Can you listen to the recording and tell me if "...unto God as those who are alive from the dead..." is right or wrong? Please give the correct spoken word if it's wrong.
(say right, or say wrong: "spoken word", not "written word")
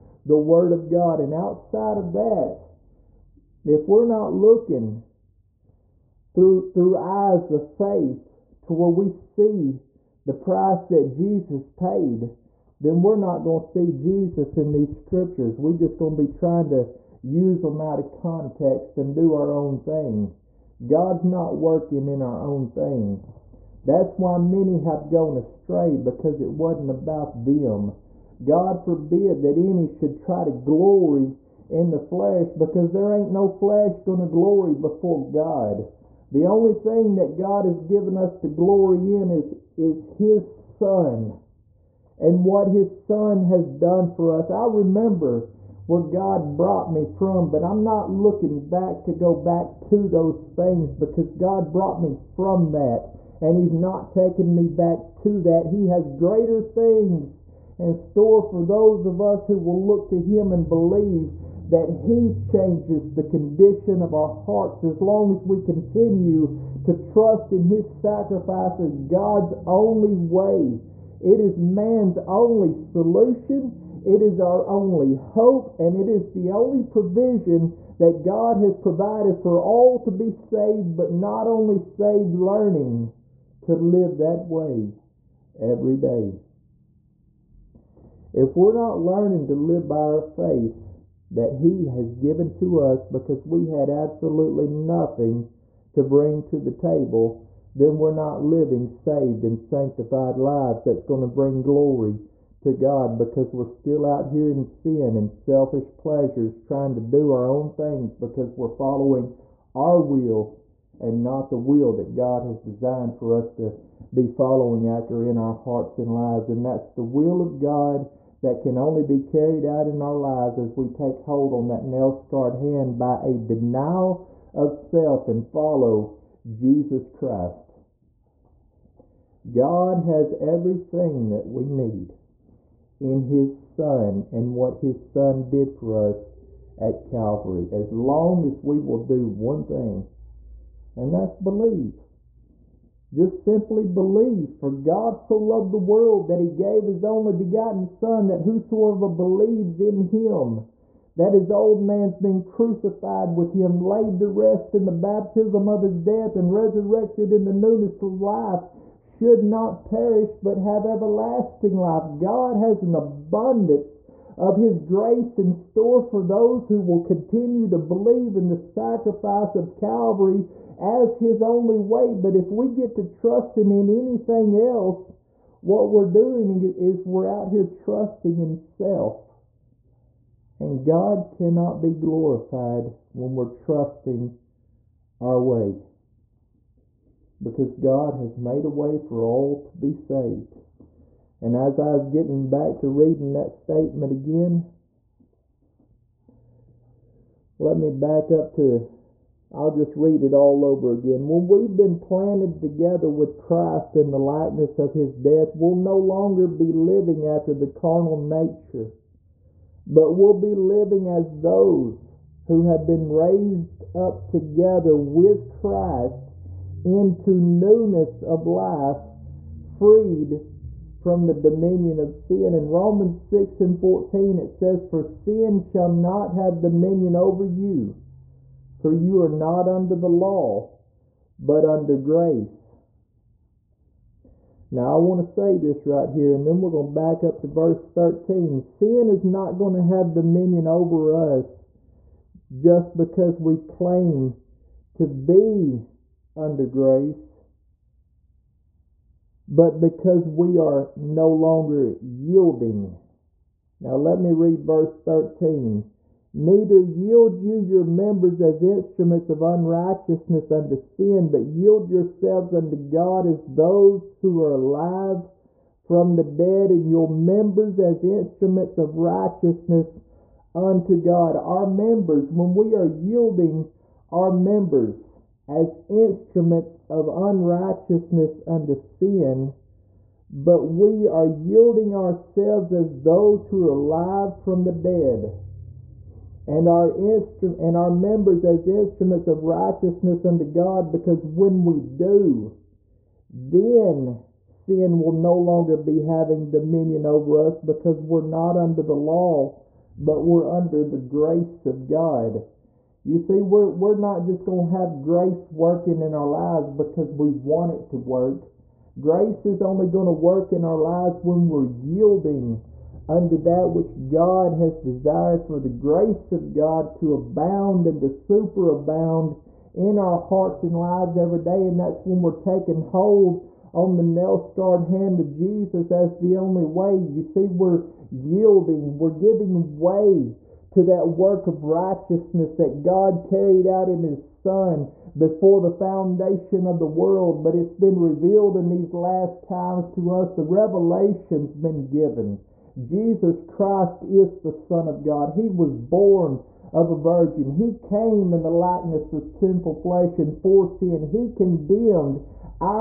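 right.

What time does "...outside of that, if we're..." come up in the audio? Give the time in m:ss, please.
0:01.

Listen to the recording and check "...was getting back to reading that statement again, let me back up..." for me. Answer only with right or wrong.
right.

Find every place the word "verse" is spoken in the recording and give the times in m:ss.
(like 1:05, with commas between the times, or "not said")
3:57, 4:14.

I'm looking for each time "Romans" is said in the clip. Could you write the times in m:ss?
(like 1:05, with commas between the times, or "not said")
3:42.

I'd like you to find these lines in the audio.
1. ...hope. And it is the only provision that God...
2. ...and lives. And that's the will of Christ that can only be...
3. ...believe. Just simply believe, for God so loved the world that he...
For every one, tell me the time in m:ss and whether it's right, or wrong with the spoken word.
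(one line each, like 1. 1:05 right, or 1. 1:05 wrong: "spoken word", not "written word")
1. 1:15 right
2. 1:55 wrong: "God", not "Christ"
3. 2:21 right.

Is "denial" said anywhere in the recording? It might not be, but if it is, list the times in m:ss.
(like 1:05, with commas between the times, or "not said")
2:03.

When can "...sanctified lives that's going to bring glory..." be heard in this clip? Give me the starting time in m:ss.
1:39.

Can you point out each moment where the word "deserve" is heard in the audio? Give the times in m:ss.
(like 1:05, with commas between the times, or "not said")
not said.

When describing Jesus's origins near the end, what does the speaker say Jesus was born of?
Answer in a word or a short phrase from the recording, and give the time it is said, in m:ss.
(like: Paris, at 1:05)
A virgin, at 5:46.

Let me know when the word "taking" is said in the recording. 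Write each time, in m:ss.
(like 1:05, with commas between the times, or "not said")
0:54, 5:22.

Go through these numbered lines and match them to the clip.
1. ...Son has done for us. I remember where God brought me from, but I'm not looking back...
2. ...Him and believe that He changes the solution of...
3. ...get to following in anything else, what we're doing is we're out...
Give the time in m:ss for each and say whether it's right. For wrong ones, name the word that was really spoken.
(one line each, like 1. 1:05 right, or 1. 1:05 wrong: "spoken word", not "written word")
1. 0:43 right
2. 1:00 wrong: "condition", not "solution"
3. 2:52 wrong: "trusting", not "following".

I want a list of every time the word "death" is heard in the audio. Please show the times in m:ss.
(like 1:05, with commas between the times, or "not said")
2:36, 3:25.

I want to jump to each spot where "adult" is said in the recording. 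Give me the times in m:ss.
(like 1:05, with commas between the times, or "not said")
not said.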